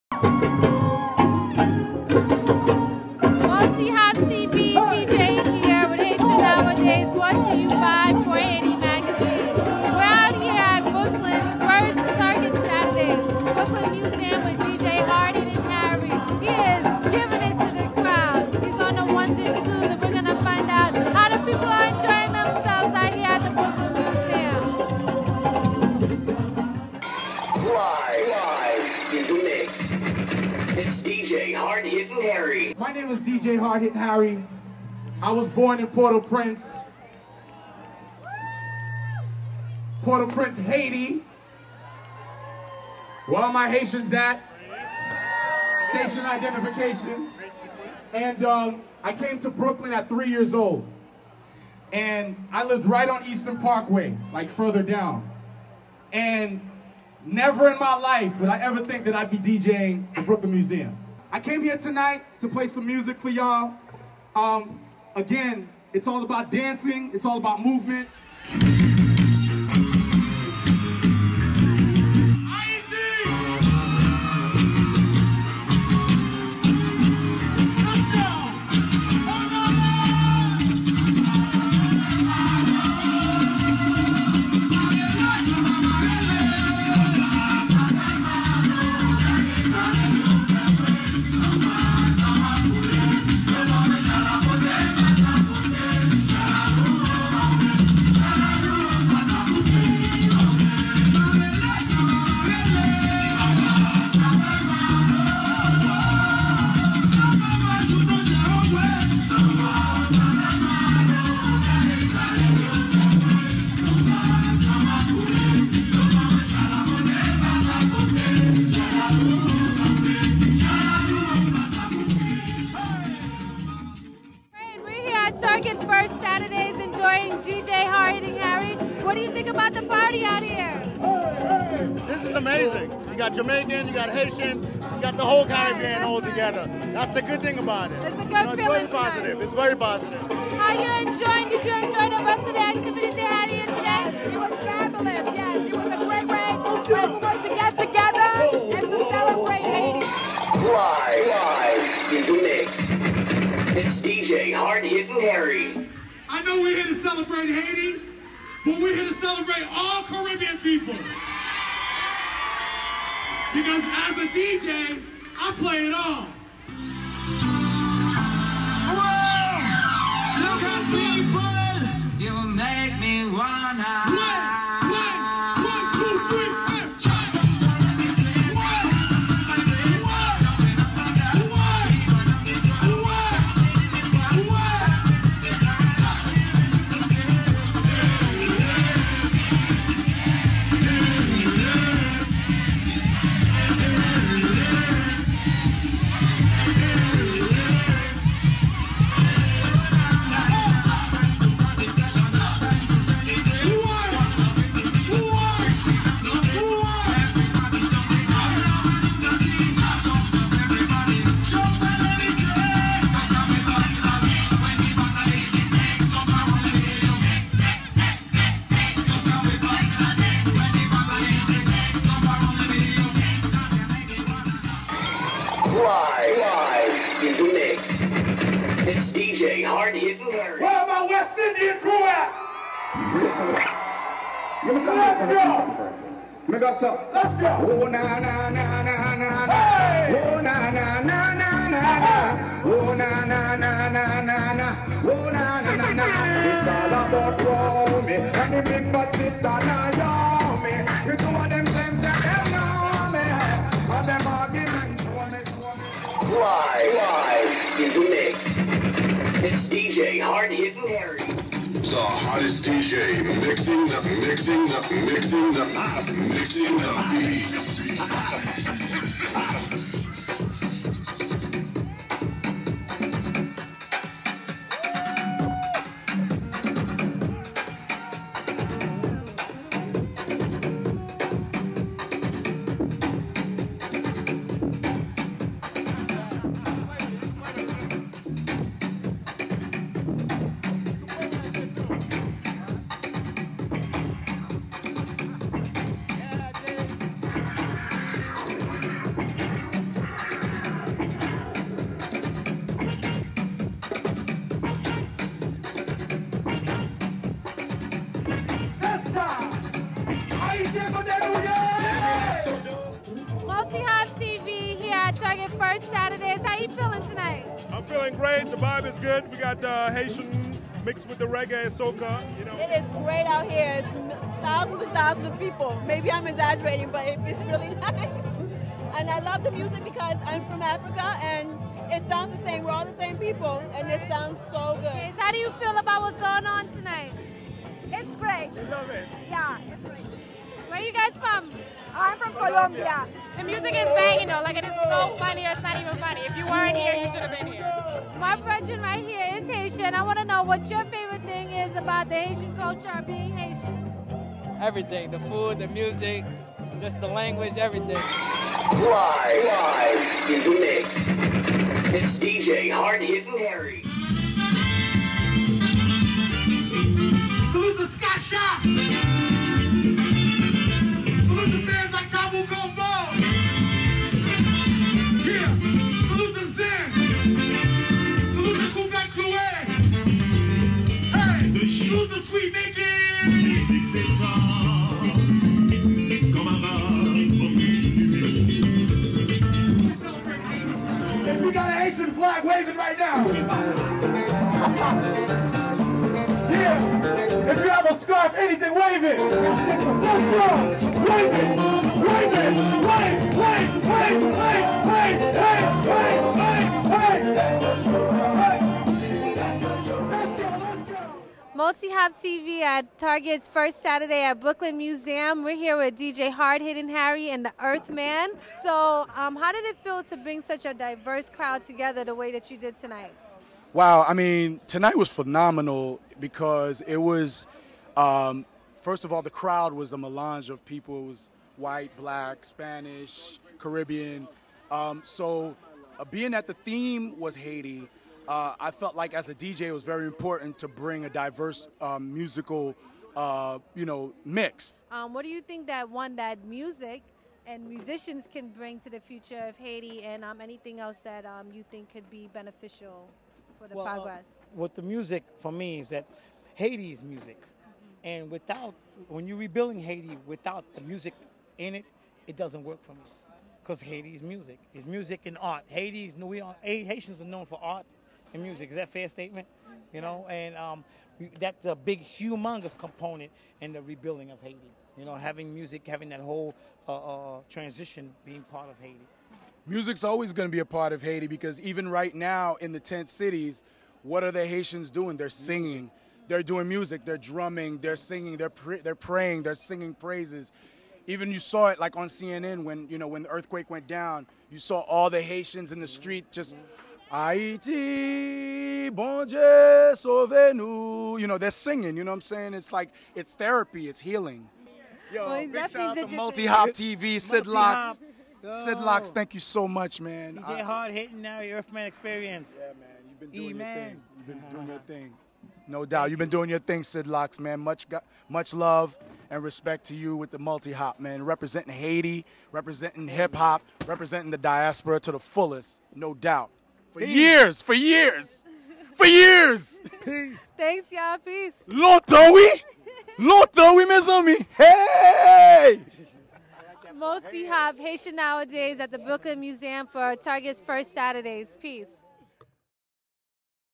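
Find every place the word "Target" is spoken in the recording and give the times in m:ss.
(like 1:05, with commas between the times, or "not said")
6:52, 9:00.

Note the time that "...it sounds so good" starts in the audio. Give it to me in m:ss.
5:33.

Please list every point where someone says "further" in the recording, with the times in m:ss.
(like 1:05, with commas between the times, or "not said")
0:54.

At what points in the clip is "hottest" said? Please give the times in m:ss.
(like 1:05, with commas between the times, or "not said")
4:21.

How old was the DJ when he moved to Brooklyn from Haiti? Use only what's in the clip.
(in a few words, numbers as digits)
3.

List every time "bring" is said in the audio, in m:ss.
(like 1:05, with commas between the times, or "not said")
7:00, 7:20, 7:28.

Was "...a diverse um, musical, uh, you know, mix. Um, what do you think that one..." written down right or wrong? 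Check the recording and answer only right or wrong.
right.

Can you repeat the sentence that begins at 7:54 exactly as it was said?
You know, having music, having that whole uh, uh, transition being part of Haiti.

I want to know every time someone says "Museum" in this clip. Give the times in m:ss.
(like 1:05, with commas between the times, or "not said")
1:00, 6:54, 8:59.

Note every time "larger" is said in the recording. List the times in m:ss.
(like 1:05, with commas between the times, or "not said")
not said.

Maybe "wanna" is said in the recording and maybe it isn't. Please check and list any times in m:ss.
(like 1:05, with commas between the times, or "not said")
2:53.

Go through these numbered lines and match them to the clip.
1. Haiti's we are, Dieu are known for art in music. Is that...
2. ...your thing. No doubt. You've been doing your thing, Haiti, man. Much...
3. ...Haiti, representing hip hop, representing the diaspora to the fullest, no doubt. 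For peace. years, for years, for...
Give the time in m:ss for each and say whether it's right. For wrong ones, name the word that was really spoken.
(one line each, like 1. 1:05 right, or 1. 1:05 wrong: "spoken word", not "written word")
1. 7:45 wrong: "Haitians", not "Dieu"
2. 8:34 wrong: "SidLocks", not "Haiti"
3. 8:41 right.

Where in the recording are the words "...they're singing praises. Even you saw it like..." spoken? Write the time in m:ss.
8:09.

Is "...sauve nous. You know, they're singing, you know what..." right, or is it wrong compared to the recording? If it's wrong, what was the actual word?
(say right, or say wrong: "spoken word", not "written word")
right.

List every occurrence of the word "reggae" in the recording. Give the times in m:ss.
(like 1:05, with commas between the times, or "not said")
5:21.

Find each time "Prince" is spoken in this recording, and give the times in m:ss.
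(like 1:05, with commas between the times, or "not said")
0:35, 0:40.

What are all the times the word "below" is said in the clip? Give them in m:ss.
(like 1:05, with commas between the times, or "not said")
not said.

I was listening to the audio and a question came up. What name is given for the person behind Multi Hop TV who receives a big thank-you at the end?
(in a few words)
Sid Locks.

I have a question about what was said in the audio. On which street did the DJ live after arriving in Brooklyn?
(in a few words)
Eastern Parkway.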